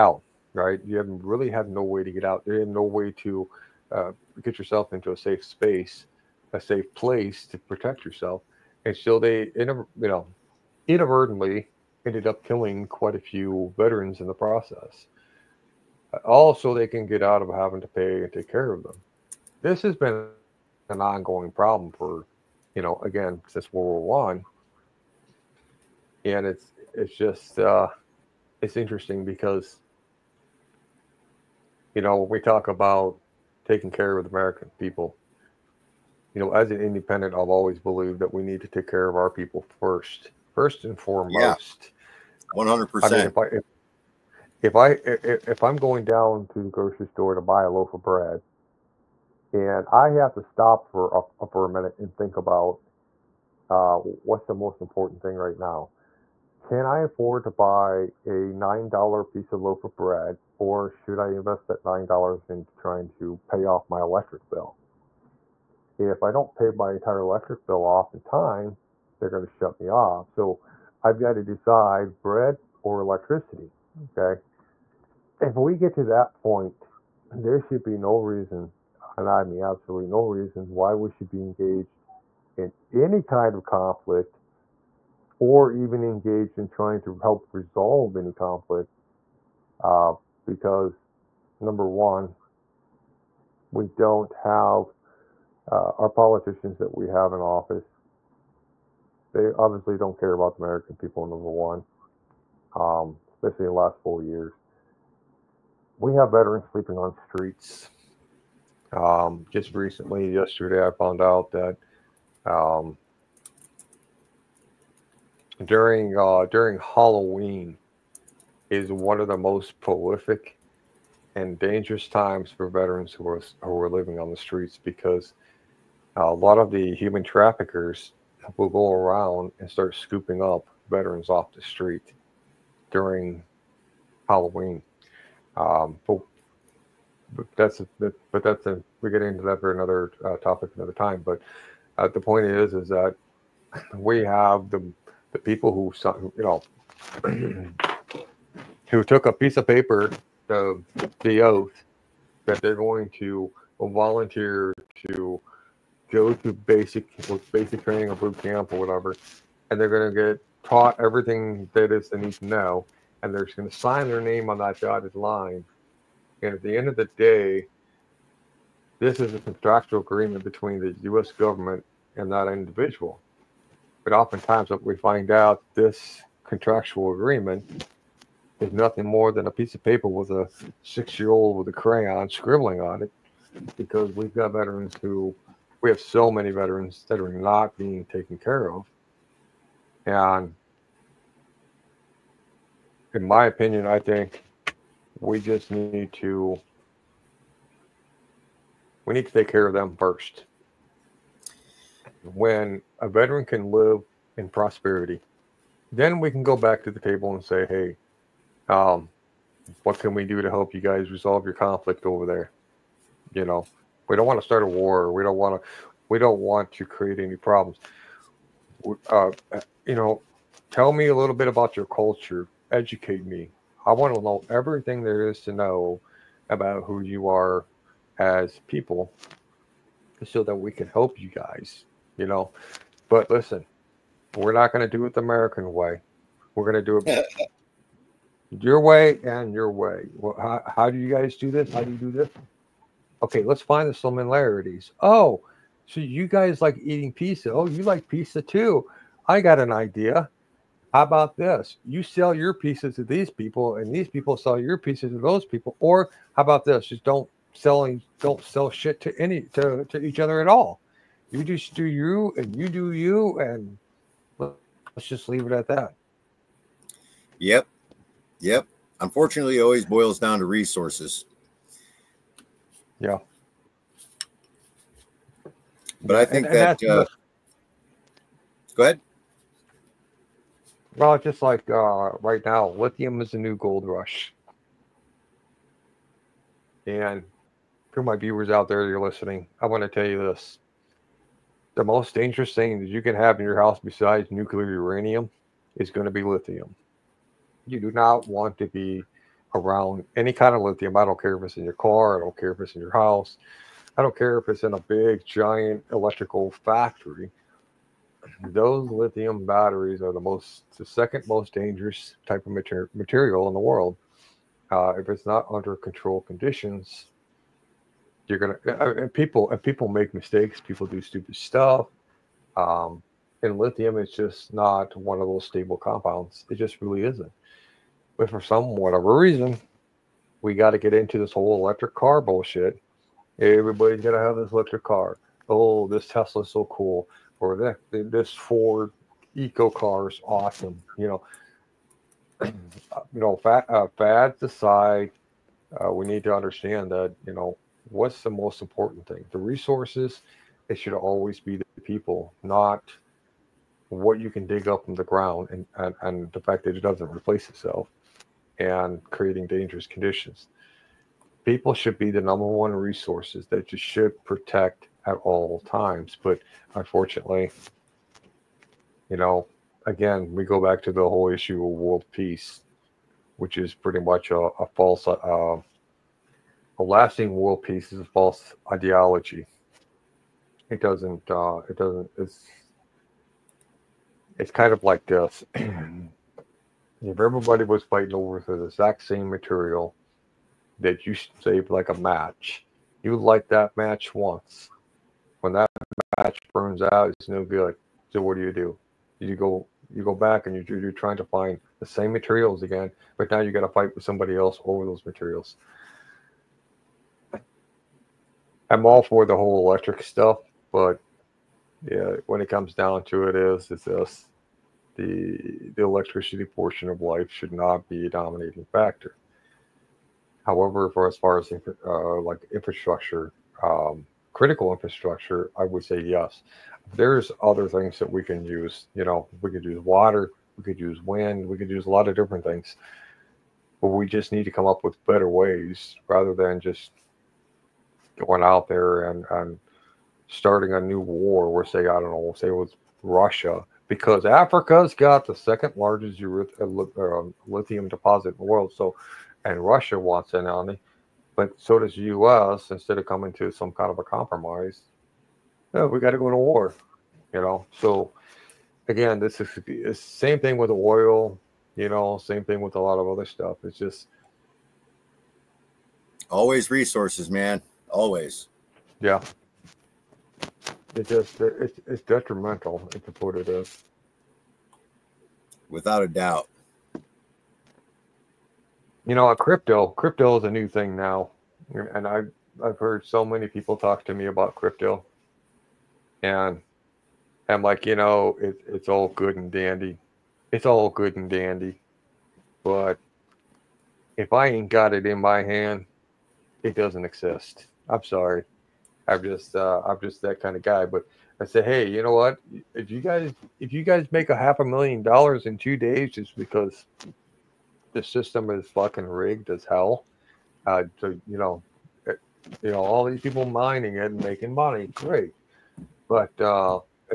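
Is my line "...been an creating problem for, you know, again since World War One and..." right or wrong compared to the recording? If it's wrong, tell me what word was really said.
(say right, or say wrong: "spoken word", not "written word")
wrong: "ongoing", not "creating".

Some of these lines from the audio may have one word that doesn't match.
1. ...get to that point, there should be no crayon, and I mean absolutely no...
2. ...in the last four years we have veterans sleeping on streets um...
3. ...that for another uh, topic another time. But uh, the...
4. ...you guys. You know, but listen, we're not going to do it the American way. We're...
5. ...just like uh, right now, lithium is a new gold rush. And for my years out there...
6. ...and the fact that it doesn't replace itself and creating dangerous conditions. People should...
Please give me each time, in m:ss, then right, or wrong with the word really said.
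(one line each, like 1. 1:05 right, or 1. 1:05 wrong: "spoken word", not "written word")
1. 1:15 wrong: "reason", not "crayon"
2. 1:43 right
3. 2:19 right
4. 3:51 right
5. 4:41 wrong: "viewers", not "years"
6. 5:56 right.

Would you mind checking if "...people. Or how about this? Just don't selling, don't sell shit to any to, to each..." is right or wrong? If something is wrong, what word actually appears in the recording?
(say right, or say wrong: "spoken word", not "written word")
right.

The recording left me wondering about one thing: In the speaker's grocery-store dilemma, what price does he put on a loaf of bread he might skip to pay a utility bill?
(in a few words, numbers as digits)
$9.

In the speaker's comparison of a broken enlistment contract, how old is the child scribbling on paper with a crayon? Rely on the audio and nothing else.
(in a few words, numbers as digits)
six.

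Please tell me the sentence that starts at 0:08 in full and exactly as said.
And so they, you know, inadvertently ended up killing quite a few veterans in the process.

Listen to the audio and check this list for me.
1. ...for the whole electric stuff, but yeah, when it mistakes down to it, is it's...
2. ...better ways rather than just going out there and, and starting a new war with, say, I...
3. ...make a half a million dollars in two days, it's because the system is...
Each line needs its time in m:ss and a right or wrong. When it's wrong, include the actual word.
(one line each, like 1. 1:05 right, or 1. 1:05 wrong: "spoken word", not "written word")
1. 6:49 wrong: "comes", not "mistakes"
2. 7:15 right
3. 8:24 right.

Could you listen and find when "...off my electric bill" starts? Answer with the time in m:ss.
1:03.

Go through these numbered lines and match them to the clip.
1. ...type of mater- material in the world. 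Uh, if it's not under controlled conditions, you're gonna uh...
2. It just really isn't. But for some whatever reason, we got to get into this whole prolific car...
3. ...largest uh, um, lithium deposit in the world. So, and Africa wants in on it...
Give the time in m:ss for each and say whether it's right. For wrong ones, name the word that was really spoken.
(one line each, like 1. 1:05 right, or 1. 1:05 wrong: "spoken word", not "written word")
1. 5:12 right
2. 5:26 wrong: "electric", not "prolific"
3. 7:25 wrong: "Russia", not "Africa".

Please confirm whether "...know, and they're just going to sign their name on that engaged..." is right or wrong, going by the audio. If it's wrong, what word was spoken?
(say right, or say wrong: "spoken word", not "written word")
wrong: "dotted", not "engaged".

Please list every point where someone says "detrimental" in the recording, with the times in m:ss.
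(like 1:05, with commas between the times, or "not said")
7:52.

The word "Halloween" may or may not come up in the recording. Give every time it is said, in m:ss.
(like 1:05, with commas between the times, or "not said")
1:56, 2:14.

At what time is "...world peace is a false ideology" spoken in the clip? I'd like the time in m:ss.
6:17.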